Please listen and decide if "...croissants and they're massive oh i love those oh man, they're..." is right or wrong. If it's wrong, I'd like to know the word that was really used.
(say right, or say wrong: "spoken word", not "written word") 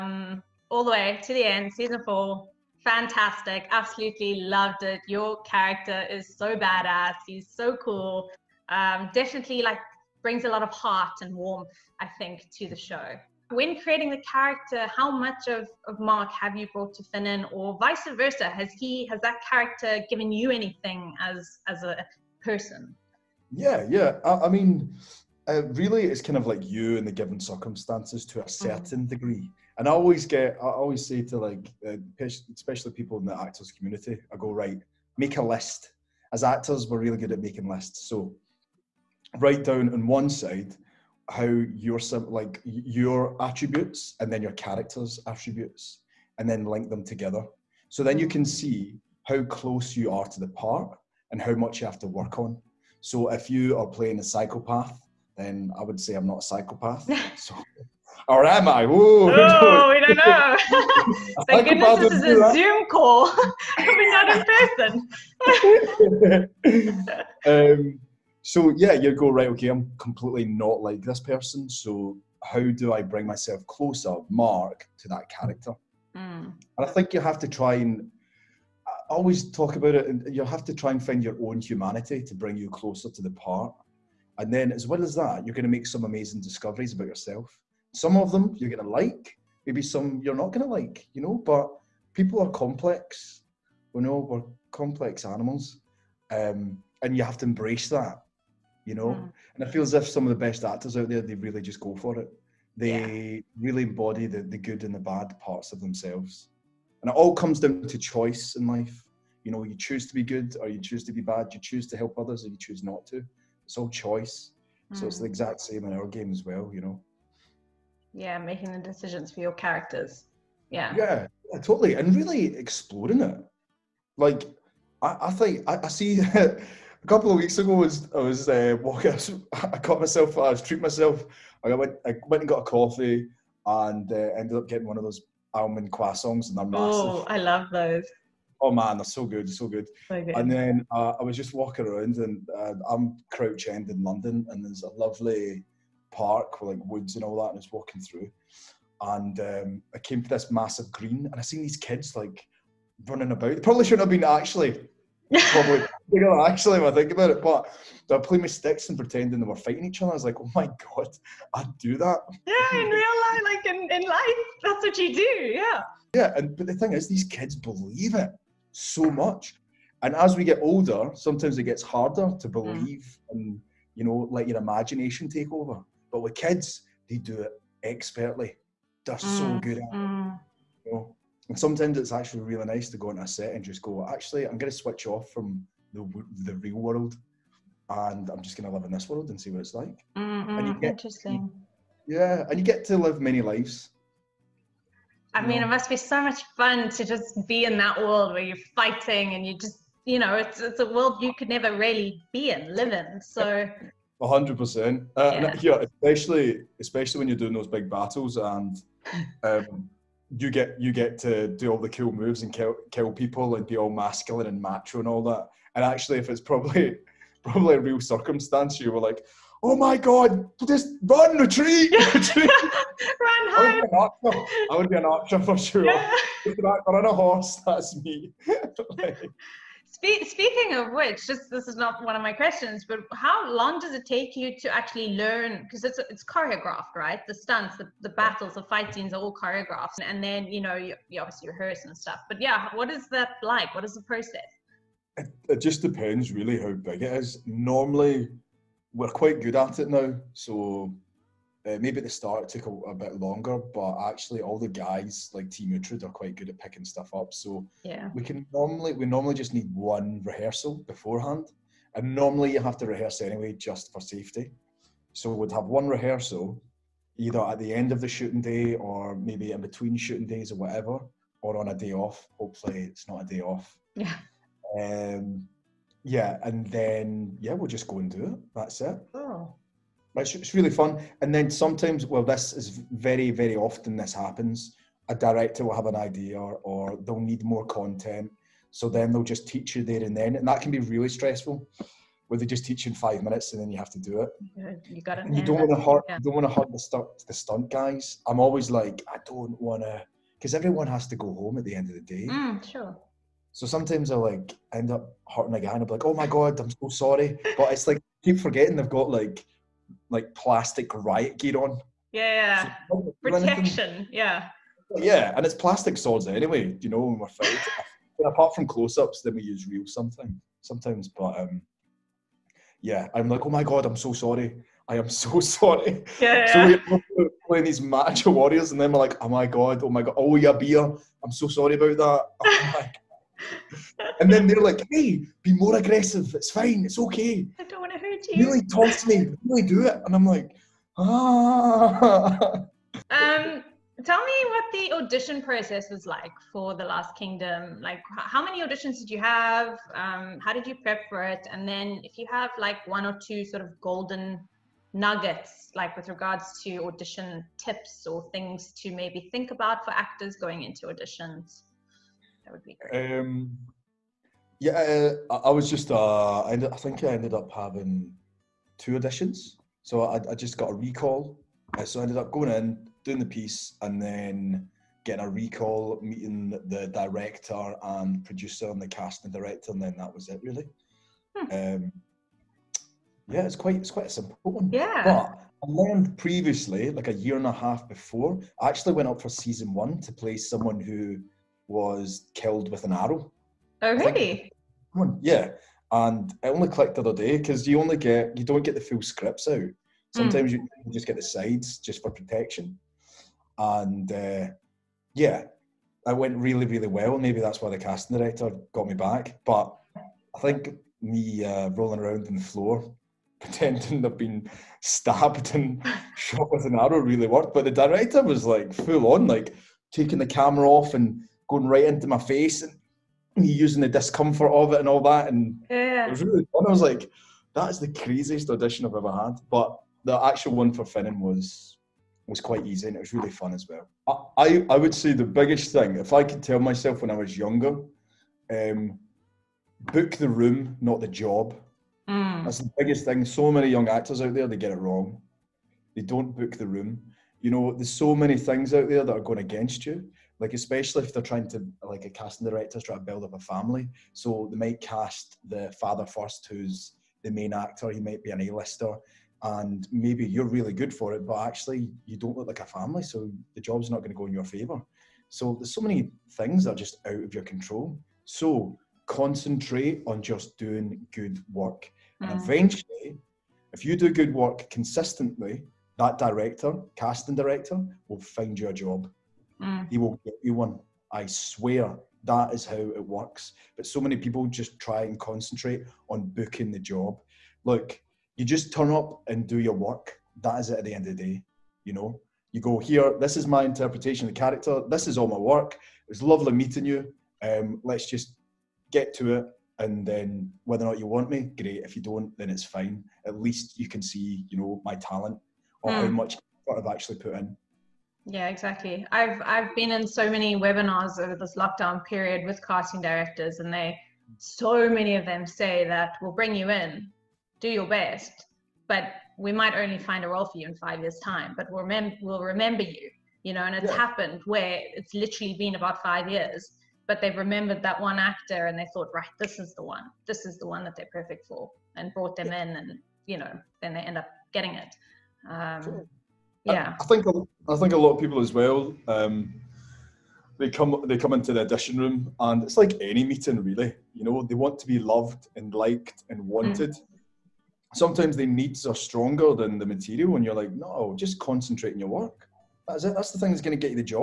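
right.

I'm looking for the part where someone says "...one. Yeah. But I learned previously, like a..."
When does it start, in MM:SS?
06:24.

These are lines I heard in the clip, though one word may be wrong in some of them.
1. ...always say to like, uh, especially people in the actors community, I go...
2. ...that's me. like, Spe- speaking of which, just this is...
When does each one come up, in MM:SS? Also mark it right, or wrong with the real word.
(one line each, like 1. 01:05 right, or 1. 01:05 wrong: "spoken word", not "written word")
1. 00:30 right
2. 03:47 right.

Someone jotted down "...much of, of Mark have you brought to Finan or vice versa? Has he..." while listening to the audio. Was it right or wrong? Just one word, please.
right.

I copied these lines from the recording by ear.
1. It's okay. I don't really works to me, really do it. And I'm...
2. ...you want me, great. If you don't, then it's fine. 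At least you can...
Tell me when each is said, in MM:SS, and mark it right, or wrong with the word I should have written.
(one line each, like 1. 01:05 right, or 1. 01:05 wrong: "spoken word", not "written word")
1. 05:36 wrong: "talks", not "works"
2. 08:20 right.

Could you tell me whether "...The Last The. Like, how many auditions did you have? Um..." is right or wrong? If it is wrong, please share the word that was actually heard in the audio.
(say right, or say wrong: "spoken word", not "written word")
wrong: "Kingdom", not "The".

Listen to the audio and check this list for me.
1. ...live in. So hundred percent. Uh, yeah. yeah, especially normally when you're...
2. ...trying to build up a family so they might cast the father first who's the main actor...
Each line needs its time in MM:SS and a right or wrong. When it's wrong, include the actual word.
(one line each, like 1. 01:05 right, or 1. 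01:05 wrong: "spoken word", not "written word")
1. 03:22 wrong: "especially", not "normally"
2. 07:32 right.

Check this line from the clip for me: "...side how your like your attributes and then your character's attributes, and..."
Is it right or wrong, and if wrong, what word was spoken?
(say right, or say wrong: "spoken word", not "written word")
right.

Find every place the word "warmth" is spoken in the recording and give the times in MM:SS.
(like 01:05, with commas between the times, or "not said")
00:11.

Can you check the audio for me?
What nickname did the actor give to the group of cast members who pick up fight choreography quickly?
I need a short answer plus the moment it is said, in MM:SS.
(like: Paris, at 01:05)
Team Uhtred, at 04:15.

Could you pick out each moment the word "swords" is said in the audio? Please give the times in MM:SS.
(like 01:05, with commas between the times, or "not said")
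05:15.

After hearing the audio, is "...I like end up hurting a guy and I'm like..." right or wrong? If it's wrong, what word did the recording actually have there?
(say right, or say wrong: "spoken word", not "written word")
right.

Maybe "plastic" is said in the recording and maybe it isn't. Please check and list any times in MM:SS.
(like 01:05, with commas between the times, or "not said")
05:10, 05:15.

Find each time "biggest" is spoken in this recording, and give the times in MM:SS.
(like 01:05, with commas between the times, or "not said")
07:15, 07:22.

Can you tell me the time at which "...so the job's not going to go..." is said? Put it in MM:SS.
07:43.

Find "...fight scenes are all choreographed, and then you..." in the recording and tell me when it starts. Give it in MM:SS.
03:58.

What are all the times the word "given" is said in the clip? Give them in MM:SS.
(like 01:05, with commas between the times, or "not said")
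00:20, 00:27.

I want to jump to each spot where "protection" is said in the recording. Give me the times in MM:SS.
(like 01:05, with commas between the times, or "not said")
05:13, 06:42.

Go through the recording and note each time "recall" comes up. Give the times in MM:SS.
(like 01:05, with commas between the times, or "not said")
06:10, 06:15.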